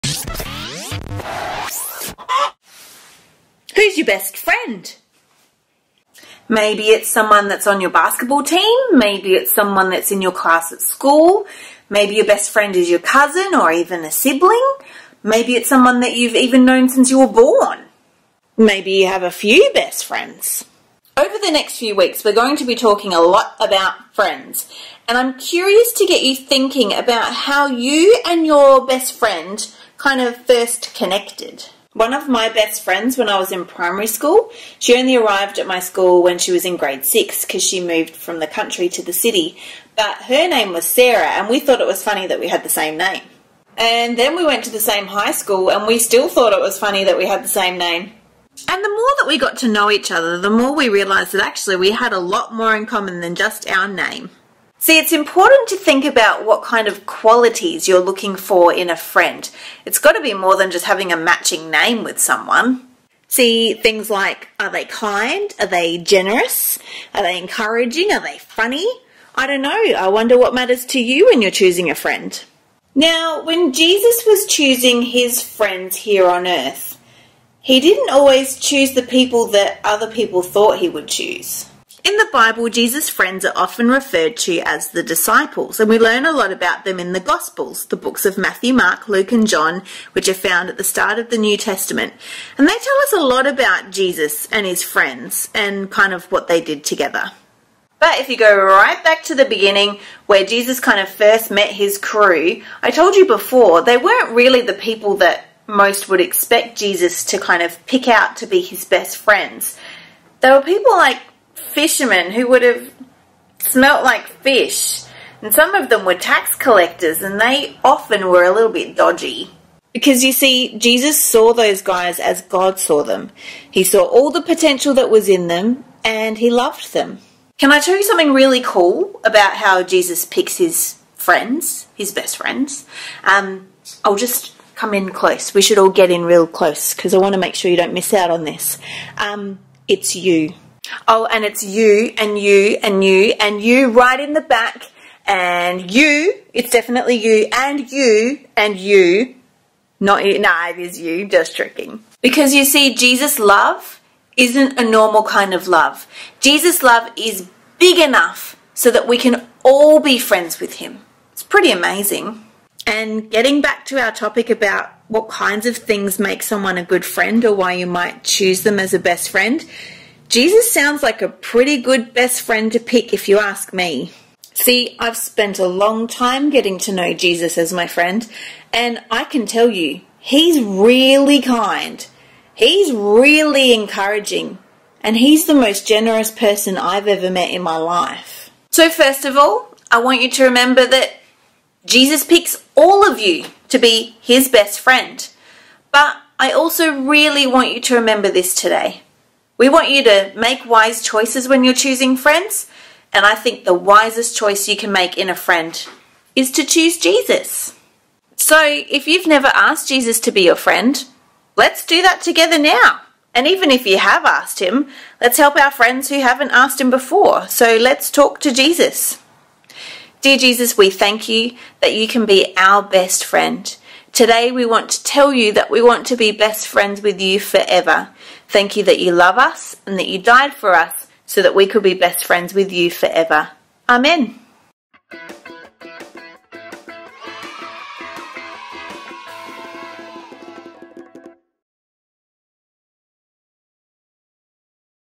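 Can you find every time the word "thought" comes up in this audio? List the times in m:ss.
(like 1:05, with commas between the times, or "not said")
0:41, 0:46, 1:20.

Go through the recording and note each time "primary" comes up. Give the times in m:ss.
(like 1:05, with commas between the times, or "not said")
0:33.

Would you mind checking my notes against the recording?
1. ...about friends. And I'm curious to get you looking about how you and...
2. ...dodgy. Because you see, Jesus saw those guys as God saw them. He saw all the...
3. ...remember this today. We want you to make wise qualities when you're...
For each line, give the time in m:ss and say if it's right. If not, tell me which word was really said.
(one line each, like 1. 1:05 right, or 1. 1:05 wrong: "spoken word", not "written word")
1. 0:23 wrong: "thinking", not "looking"
2. 1:58 right
3. 3:17 wrong: "choices", not "qualities".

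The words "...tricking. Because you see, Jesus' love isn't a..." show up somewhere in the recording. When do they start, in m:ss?
2:31.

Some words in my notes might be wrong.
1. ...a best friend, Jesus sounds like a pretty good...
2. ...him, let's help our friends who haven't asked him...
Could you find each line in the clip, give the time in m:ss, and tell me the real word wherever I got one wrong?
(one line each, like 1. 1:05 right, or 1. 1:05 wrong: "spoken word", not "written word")
1. 2:48 right
2. 3:34 right.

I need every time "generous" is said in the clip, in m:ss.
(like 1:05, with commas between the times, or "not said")
1:05, 3:05.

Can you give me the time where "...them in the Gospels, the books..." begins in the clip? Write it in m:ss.
1:26.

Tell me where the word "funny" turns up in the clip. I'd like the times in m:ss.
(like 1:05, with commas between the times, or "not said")
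0:42, 0:46, 1:08.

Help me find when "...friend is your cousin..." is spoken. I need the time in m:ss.
0:12.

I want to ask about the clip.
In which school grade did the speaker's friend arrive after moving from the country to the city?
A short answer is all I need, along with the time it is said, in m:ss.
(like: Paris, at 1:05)
Grade 6, at 0:36.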